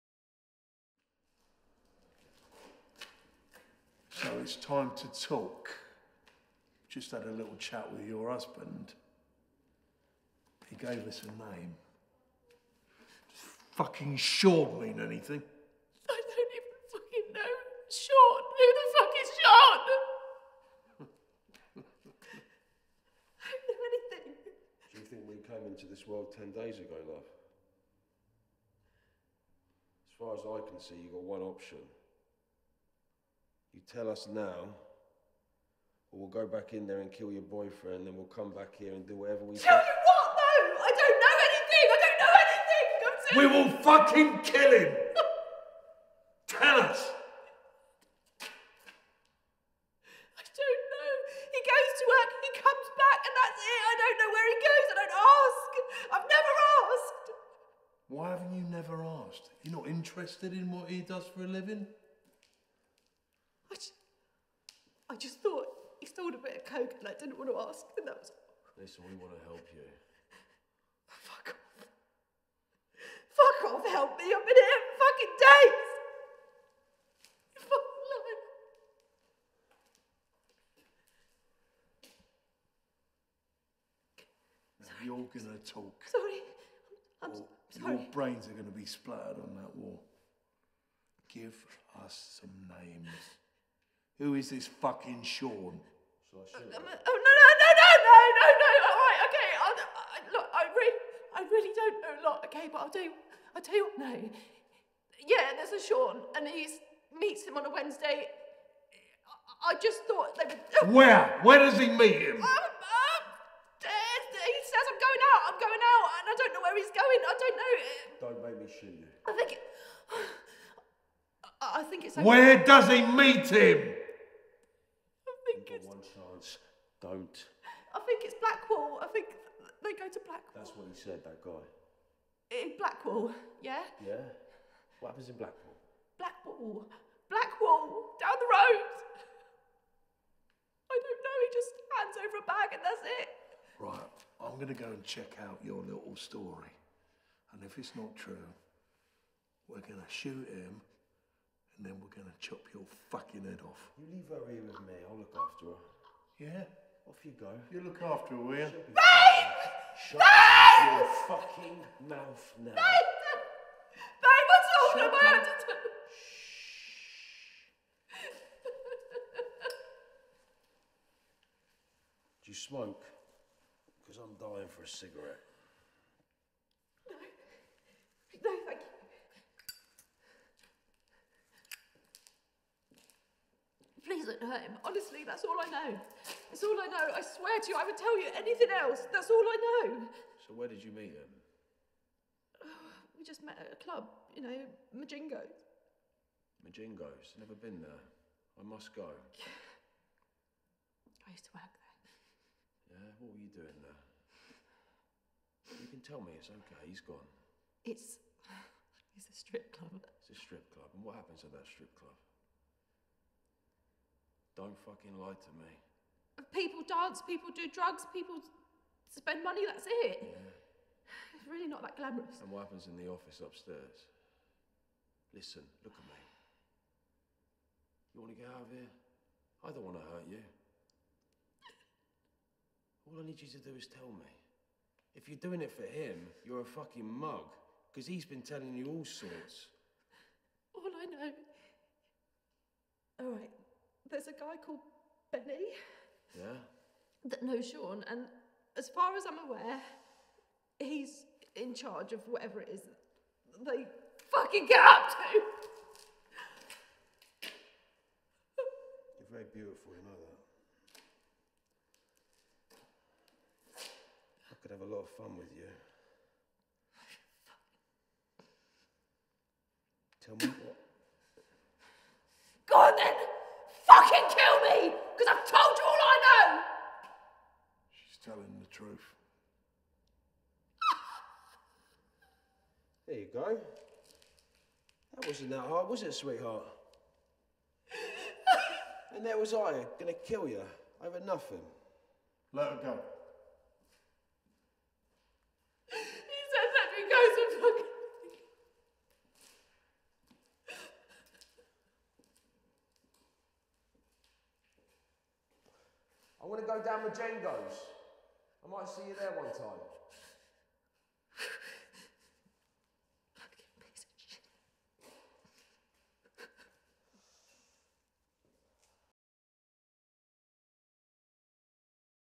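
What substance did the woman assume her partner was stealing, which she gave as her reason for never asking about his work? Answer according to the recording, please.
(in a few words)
coke.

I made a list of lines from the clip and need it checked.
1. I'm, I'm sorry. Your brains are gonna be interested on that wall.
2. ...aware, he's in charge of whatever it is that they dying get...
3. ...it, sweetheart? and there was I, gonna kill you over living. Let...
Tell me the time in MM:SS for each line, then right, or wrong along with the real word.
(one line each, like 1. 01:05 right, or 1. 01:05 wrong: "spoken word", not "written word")
1. 01:27 wrong: "splattered", not "interested"
2. 04:09 wrong: "fucking", not "dying"
3. 04:46 wrong: "nothing", not "living".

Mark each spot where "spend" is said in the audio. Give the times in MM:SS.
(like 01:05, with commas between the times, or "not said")
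03:39.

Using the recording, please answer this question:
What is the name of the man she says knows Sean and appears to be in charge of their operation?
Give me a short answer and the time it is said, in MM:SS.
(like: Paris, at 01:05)
Benny, at 04:05.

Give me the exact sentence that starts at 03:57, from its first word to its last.
Because he's been telling you all sorts.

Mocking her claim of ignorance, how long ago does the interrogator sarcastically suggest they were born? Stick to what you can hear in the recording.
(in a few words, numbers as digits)
10 days.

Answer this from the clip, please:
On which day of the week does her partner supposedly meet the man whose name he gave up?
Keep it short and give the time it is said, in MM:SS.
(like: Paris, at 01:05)
Wednesday, at 01:47.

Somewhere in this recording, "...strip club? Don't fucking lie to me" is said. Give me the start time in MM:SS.
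03:31.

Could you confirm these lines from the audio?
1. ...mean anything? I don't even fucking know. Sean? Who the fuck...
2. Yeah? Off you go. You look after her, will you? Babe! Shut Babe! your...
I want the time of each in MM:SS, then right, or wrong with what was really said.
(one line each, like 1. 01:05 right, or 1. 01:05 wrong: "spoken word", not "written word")
1. 00:14 right
2. 02:36 right.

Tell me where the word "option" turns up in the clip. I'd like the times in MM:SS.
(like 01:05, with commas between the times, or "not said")
00:31.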